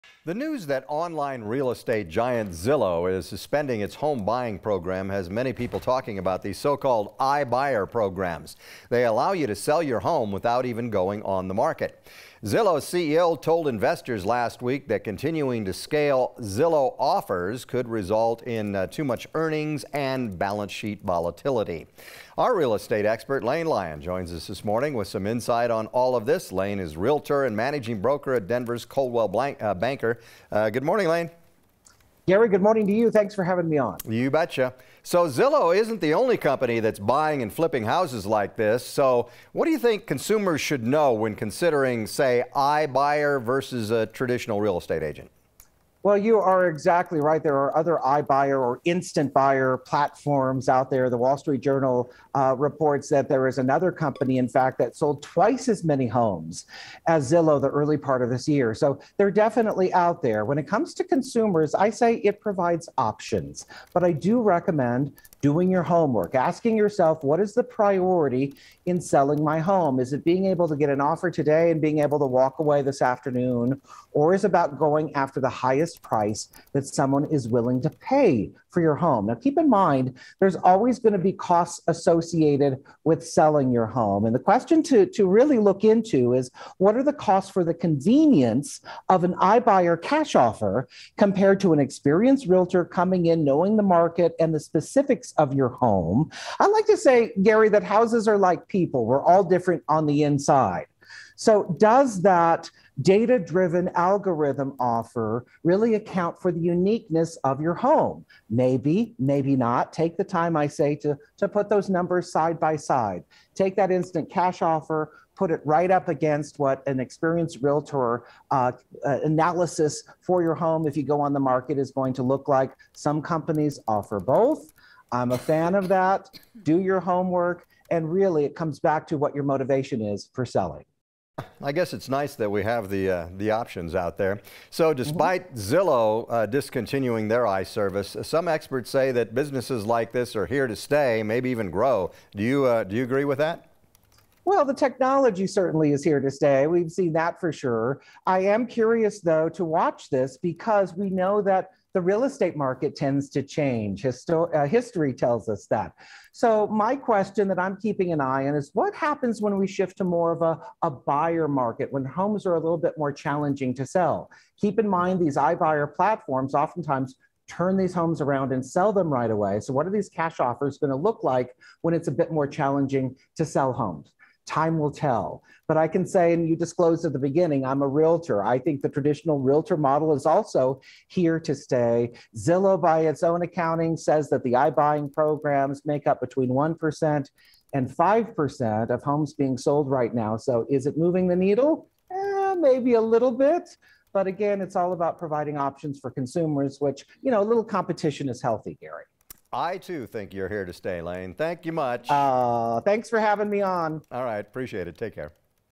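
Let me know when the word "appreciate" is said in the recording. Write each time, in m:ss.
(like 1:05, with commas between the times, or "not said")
3:24.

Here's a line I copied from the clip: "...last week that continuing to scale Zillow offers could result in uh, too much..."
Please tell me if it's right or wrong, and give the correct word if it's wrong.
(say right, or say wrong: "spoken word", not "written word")
right.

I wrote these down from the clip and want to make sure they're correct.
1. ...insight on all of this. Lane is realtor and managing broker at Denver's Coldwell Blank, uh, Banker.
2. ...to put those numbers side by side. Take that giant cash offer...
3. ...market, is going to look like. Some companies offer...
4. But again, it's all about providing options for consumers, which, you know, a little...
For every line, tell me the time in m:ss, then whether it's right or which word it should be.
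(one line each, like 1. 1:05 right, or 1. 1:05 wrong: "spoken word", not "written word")
1. 0:25 right
2. 1:51 wrong: "instant", not "giant"
3. 2:01 right
4. 3:14 right.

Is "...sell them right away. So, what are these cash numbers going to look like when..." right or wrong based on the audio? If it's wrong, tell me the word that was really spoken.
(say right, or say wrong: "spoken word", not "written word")
wrong: "offers", not "numbers".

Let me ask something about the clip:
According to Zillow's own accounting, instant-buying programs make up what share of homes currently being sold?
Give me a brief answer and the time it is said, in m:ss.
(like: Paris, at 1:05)
1% to 5%, at 3:06.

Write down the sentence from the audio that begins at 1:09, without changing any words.
Is it being able to get an offer today and being able to walk away this afternoon?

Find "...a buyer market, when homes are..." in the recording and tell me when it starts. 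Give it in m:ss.
2:40.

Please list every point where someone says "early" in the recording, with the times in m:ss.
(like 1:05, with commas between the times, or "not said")
0:57.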